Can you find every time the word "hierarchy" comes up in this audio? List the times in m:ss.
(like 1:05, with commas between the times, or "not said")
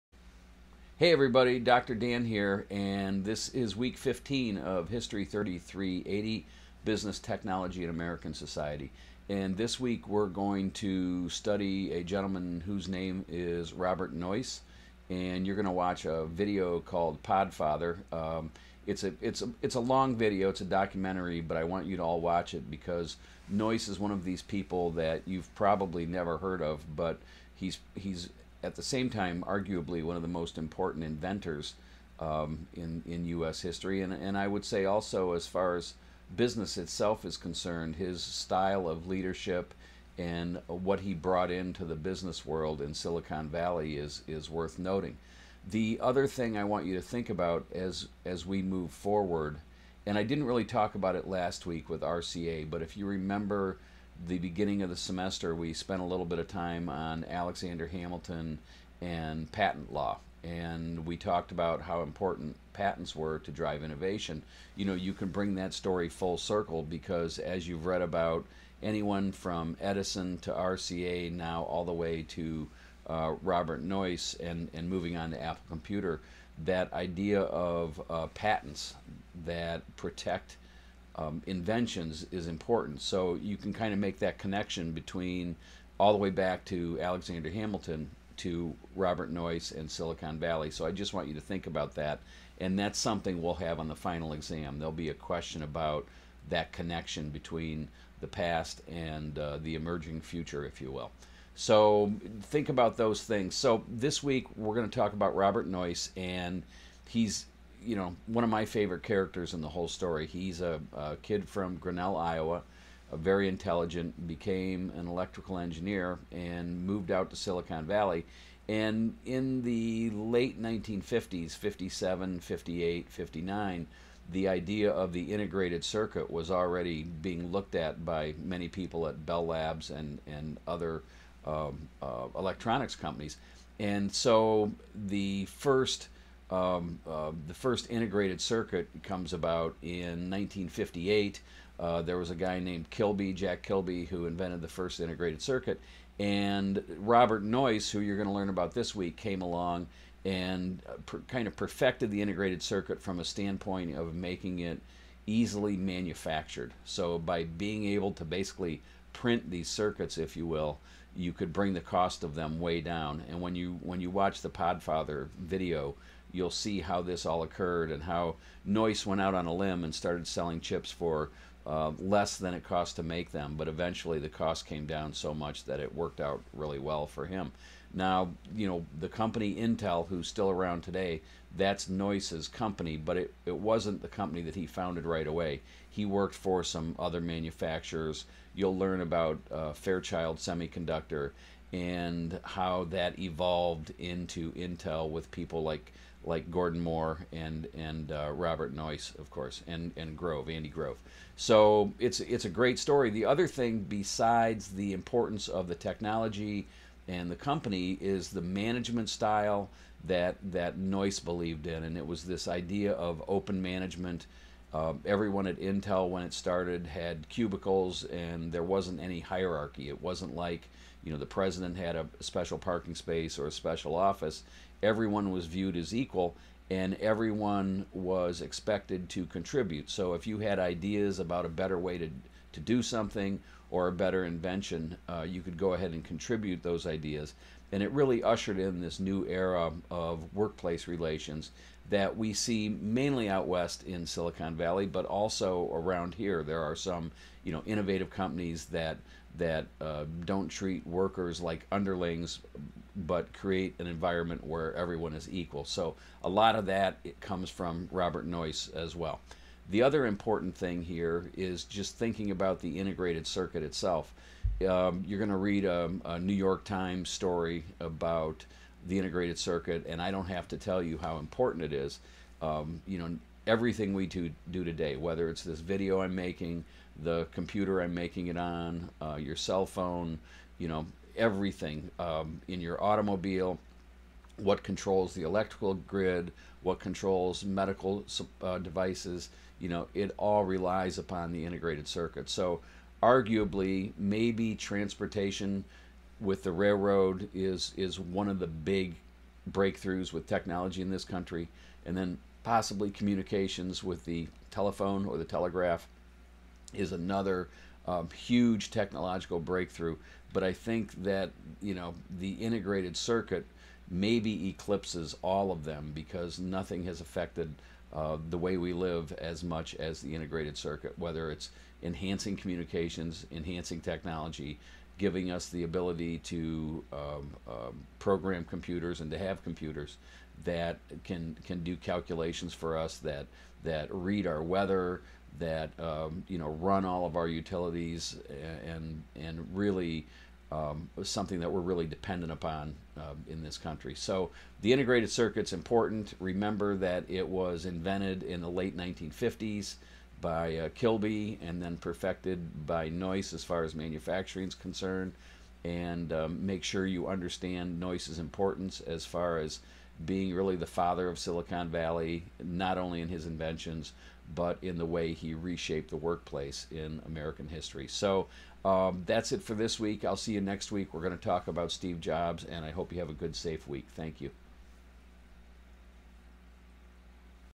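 3:39.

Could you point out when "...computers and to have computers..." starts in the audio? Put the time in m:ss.
5:28.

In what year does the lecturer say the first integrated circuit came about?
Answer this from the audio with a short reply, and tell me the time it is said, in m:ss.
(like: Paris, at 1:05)
1958, at 2:20.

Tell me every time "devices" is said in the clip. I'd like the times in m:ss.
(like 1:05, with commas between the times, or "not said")
4:48.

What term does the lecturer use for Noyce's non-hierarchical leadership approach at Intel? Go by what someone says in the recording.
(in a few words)
open management.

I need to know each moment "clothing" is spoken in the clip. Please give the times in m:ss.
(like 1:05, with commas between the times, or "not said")
not said.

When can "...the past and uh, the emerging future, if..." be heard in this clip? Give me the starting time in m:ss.
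1:38.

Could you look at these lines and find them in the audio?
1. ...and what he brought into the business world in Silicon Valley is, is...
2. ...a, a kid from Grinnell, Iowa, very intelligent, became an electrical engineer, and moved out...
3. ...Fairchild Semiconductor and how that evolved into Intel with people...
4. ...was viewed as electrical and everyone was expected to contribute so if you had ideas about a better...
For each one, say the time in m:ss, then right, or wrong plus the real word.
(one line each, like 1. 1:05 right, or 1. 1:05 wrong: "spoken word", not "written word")
1. 0:40 right
2. 1:50 right
3. 3:09 right
4. 3:45 wrong: "equal", not "electrical".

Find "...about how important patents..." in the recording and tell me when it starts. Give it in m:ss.
1:01.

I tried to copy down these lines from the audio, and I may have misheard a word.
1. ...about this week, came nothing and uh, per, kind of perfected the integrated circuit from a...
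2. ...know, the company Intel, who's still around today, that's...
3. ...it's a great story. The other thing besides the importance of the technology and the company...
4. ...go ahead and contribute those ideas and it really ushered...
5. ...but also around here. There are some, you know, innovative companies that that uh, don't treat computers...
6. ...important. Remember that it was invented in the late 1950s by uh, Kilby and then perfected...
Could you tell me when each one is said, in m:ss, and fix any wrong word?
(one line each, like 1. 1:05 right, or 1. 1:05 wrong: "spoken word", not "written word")
1. 2:28 wrong: "along", not "nothing"
2. 2:58 right
3. 3:22 right
4. 3:55 right
5. 4:04 wrong: "workers", not "computers"
6. 5:45 right.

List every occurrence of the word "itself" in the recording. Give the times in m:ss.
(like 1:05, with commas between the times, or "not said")
0:36, 4:23.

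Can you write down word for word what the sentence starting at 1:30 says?
So I just want you to think about that.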